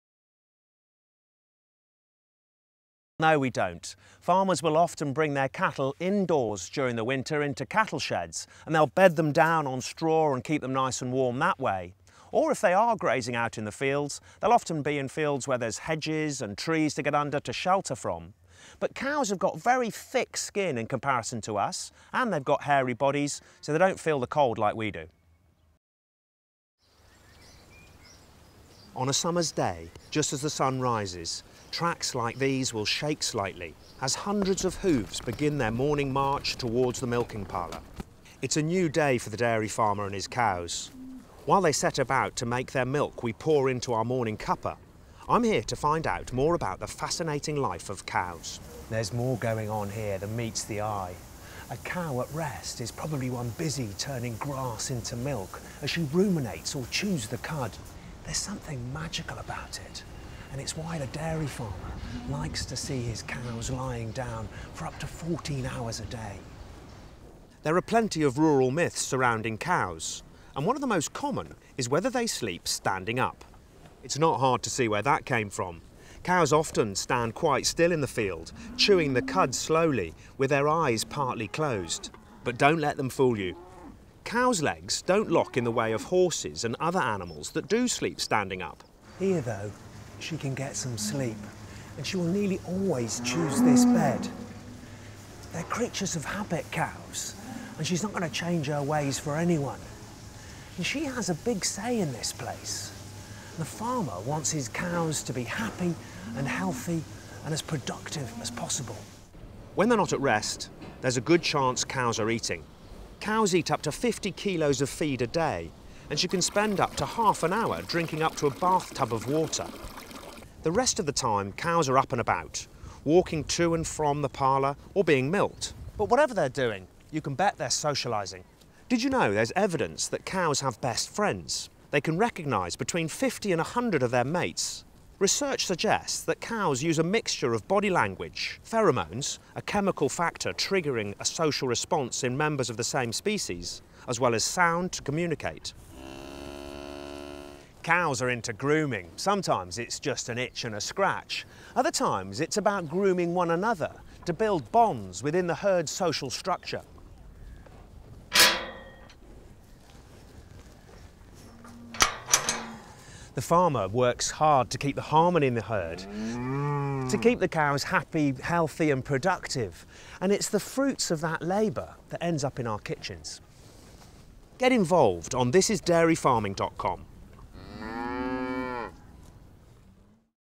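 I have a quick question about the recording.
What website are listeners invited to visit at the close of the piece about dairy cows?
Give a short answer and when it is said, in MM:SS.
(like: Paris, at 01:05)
thisisdairyfarming.com, at 02:55.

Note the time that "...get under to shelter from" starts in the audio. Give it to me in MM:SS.
00:17.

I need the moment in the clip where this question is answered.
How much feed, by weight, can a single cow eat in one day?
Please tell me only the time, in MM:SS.
01:53.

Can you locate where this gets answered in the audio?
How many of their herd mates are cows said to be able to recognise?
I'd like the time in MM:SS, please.
02:12.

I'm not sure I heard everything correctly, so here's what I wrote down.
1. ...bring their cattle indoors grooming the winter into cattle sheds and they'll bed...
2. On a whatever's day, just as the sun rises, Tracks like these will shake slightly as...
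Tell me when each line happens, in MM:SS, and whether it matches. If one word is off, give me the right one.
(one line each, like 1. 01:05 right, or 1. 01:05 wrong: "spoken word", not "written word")
1. 00:05 wrong: "during", not "grooming"
2. 00:28 wrong: "summer", not "whatever".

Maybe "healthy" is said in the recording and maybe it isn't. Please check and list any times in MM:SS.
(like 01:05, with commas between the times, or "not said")
01:46, 02:48.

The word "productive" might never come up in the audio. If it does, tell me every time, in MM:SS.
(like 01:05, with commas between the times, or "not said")
01:47, 02:49.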